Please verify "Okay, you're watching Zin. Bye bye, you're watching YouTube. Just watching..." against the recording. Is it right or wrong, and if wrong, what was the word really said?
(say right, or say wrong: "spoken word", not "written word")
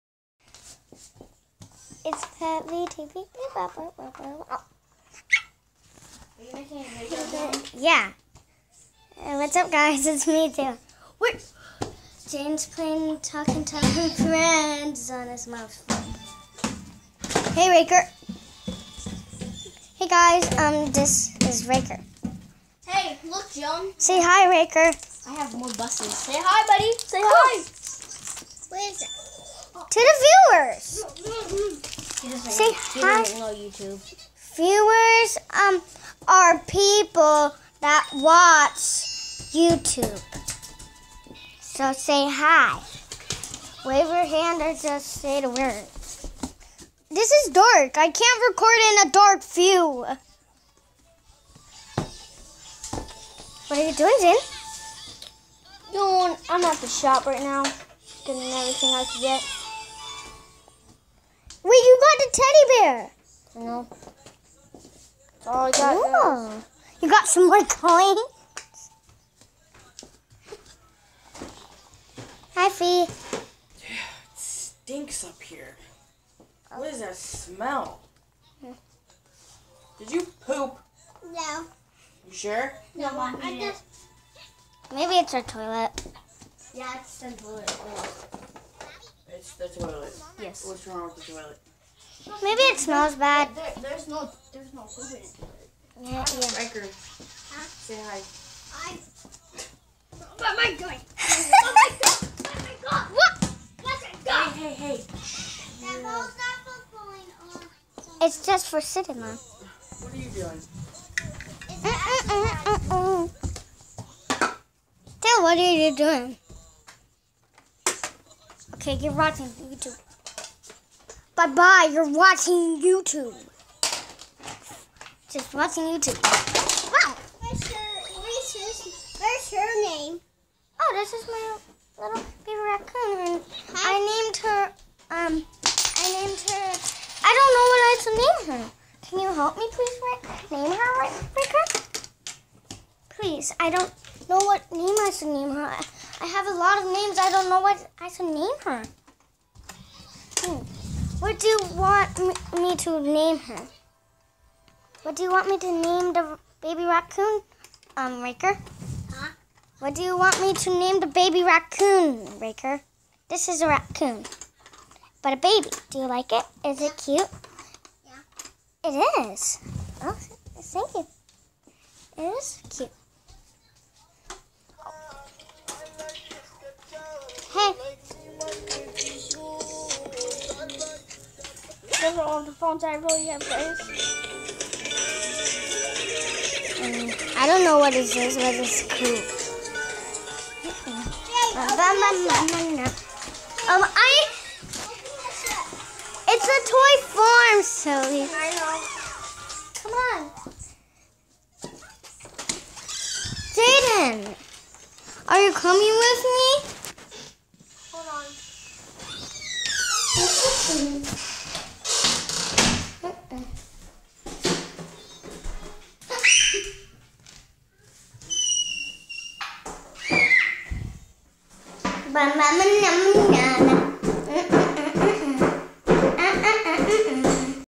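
wrong: "YouTube", not "Zin".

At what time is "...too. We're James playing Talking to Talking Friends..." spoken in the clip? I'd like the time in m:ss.
0:10.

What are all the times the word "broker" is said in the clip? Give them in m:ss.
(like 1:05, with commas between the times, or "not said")
not said.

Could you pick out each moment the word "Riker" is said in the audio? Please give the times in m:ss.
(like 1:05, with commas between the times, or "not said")
1:36.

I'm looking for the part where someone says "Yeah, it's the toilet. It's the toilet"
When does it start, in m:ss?
1:26.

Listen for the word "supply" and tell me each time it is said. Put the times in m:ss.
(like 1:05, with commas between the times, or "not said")
not said.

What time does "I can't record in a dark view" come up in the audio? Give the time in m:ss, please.
0:47.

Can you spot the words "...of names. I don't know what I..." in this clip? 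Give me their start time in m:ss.
2:26.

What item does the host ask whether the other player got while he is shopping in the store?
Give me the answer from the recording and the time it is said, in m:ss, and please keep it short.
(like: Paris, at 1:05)
teddy bear, at 1:02.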